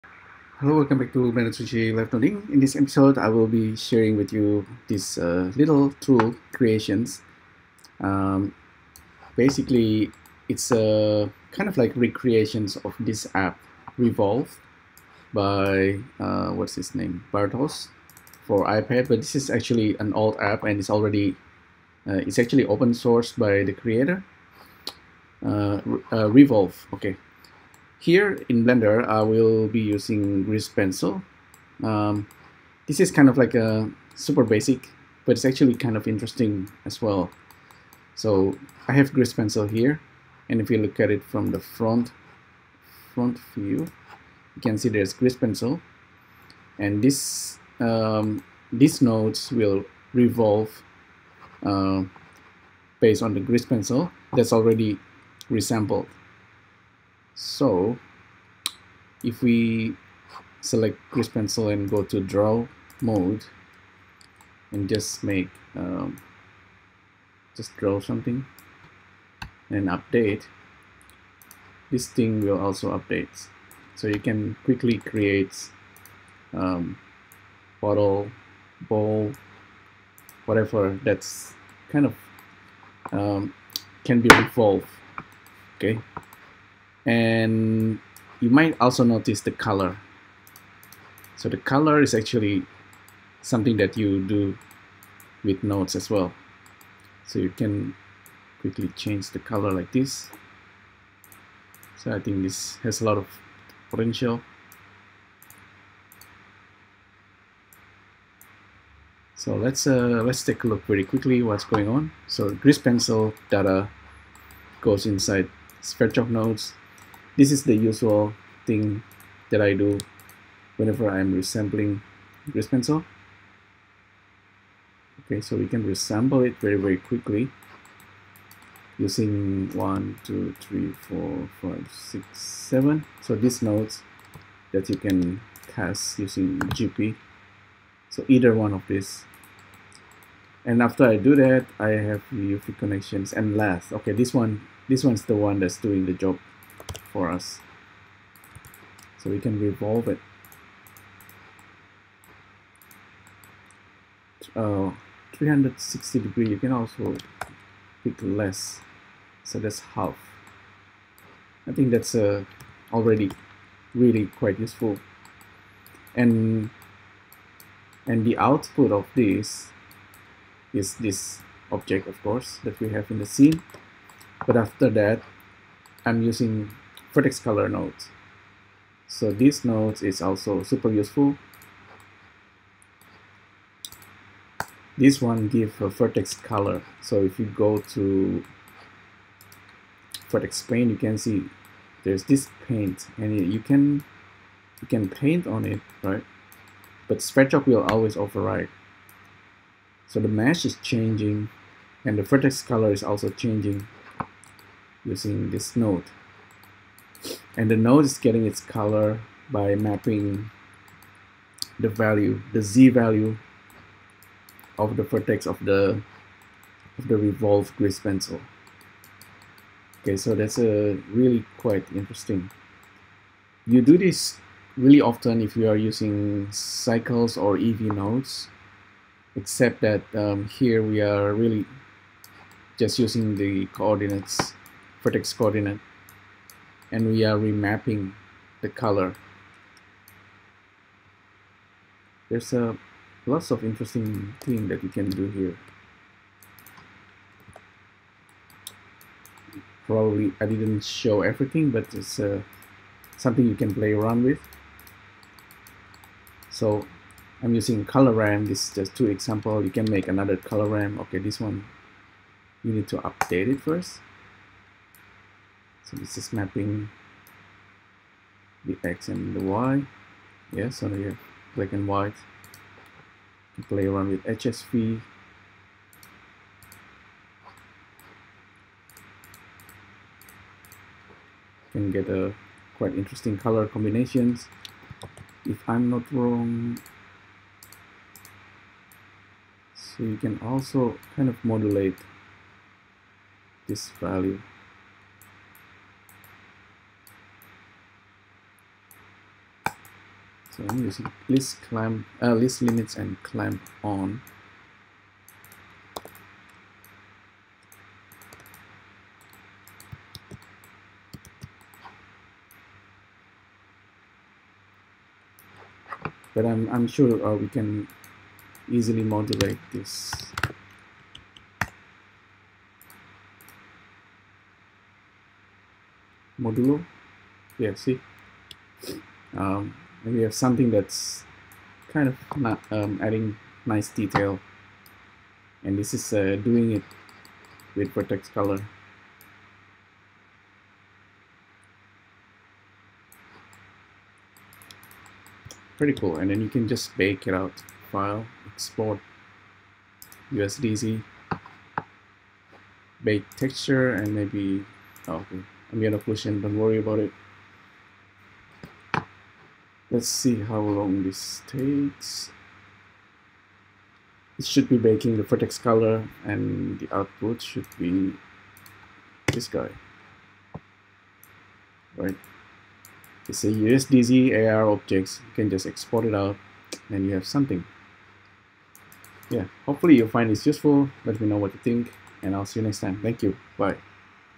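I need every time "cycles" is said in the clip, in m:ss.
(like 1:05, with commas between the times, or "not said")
3:46.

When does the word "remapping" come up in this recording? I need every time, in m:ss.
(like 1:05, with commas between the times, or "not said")
3:57.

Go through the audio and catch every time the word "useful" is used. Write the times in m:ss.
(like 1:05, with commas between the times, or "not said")
2:44, 3:00, 6:20.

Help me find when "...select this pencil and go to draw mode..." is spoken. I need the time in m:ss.
1:00.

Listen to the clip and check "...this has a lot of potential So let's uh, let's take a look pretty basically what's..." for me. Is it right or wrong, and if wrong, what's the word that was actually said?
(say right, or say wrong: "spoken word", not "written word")
wrong: "quickly", not "basically".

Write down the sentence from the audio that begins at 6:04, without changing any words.
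It should be baking the vertex color and the output should be this guy.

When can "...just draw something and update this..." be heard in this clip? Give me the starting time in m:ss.
1:07.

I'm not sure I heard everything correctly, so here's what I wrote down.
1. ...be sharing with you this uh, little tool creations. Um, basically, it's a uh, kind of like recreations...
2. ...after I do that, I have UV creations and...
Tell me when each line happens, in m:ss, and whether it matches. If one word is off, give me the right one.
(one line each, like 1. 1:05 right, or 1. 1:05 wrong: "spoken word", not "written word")
1. 0:03 right
2. 2:20 wrong: "connections", not "creations".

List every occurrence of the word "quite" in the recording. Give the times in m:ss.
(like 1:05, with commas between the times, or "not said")
2:44, 3:41, 4:42.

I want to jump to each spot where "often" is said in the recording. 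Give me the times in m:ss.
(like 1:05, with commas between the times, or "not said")
3:45.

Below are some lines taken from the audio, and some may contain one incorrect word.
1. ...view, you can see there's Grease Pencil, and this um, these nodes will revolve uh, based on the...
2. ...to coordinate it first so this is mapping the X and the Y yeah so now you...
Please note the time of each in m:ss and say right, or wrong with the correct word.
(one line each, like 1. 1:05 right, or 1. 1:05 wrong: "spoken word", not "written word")
1. 0:43 right
2. 4:22 wrong: "update", not "coordinate".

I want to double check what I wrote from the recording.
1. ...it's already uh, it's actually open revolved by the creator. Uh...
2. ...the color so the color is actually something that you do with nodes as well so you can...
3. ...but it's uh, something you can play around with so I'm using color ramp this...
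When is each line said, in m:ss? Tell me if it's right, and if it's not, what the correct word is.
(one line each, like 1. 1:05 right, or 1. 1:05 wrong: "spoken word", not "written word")
1. 0:20 wrong: "sourced", not "revolved"
2. 1:29 right
3. 4:11 right.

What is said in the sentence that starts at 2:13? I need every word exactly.
So these nodes that you can cast using GP.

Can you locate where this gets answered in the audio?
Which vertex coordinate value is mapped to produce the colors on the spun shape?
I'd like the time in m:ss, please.
3:32.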